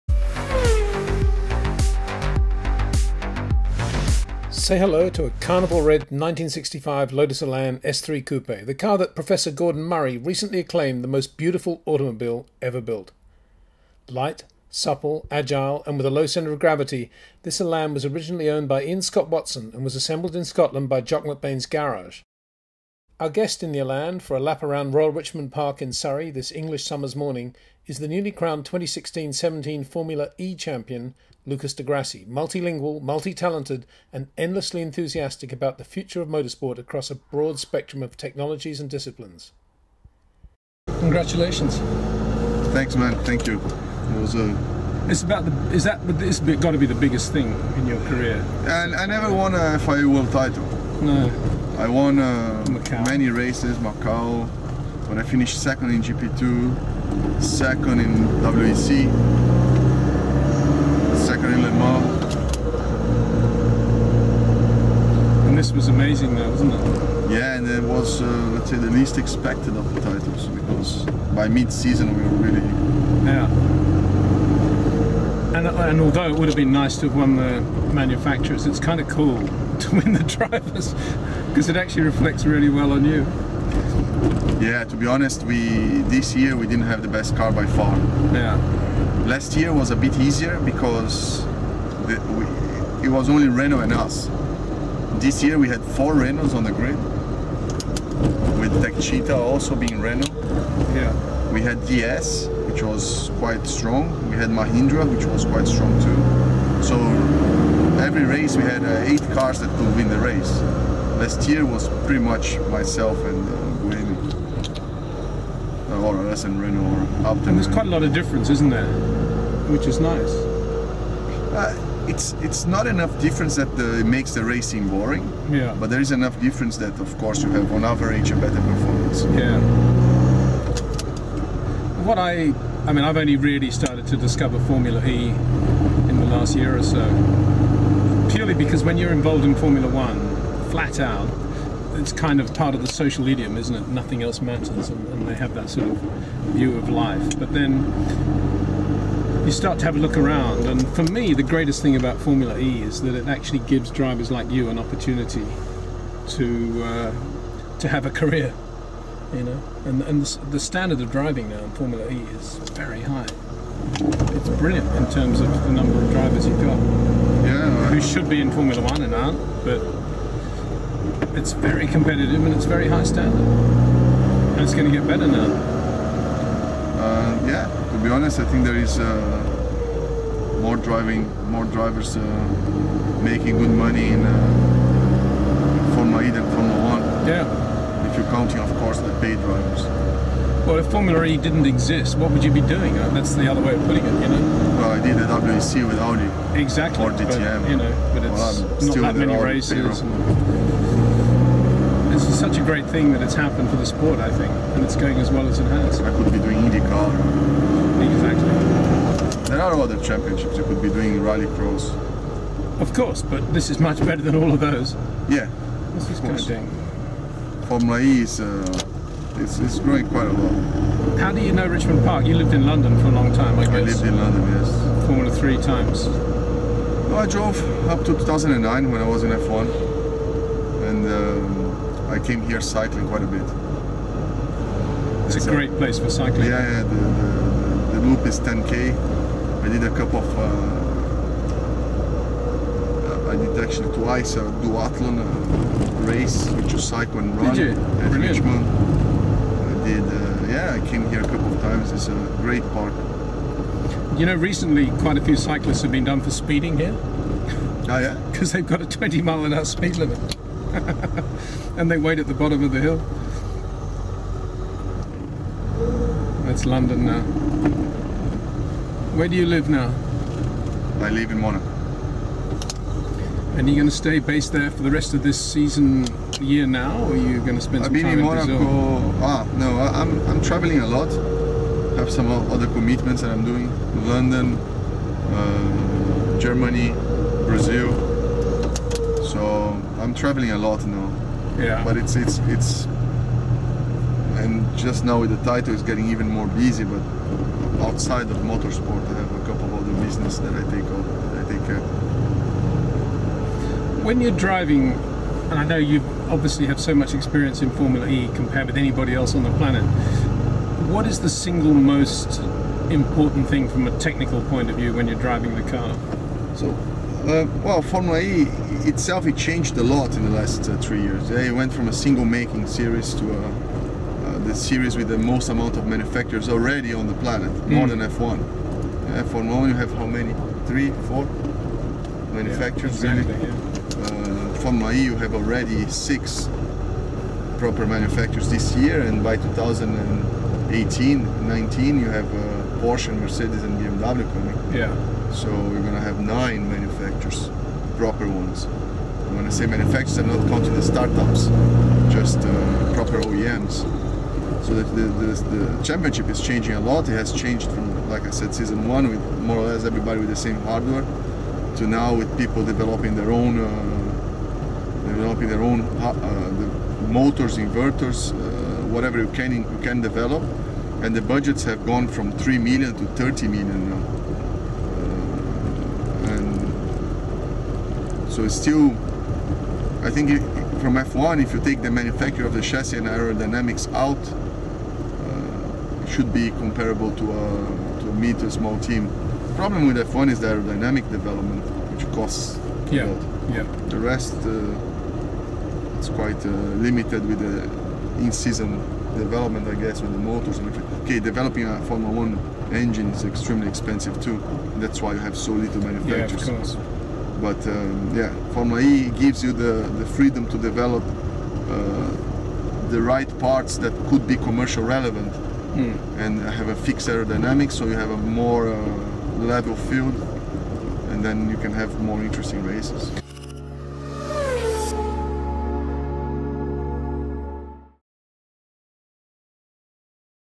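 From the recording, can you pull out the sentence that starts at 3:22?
This is such a great thing that it's happened for the sport, I think, and it's going as well as it has.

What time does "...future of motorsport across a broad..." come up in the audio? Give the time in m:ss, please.
0:35.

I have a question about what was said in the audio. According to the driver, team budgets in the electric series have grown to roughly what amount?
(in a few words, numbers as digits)
30 million.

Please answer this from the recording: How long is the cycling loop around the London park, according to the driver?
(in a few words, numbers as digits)
10k.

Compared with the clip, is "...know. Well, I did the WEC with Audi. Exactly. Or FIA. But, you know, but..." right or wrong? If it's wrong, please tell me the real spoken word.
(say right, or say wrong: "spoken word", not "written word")
wrong: "DTM", not "FIA".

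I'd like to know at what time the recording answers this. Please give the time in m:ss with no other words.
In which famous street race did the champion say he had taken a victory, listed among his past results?
0:53.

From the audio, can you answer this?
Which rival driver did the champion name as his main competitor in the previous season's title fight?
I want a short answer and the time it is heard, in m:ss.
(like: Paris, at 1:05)
Buemi, at 1:53.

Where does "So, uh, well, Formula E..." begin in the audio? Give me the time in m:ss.
5:16.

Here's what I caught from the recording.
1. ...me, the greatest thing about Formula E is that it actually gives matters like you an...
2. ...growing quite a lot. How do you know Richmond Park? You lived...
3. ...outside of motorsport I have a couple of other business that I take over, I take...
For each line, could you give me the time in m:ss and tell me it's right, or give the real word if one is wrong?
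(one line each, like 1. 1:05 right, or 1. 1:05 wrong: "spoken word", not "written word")
1. 2:31 wrong: "drivers", not "matters"
2. 3:39 right
3. 4:57 right.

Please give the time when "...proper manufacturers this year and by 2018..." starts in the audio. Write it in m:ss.
5:37.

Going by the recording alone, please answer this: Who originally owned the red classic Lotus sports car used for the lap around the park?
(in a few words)
Ian Scott Watson.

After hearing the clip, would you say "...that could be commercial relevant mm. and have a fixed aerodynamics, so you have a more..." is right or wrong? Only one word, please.
right.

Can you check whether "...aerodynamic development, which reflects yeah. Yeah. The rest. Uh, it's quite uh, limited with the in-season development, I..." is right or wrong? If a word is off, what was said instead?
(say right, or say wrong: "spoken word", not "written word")
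wrong: "costs", not "reflects".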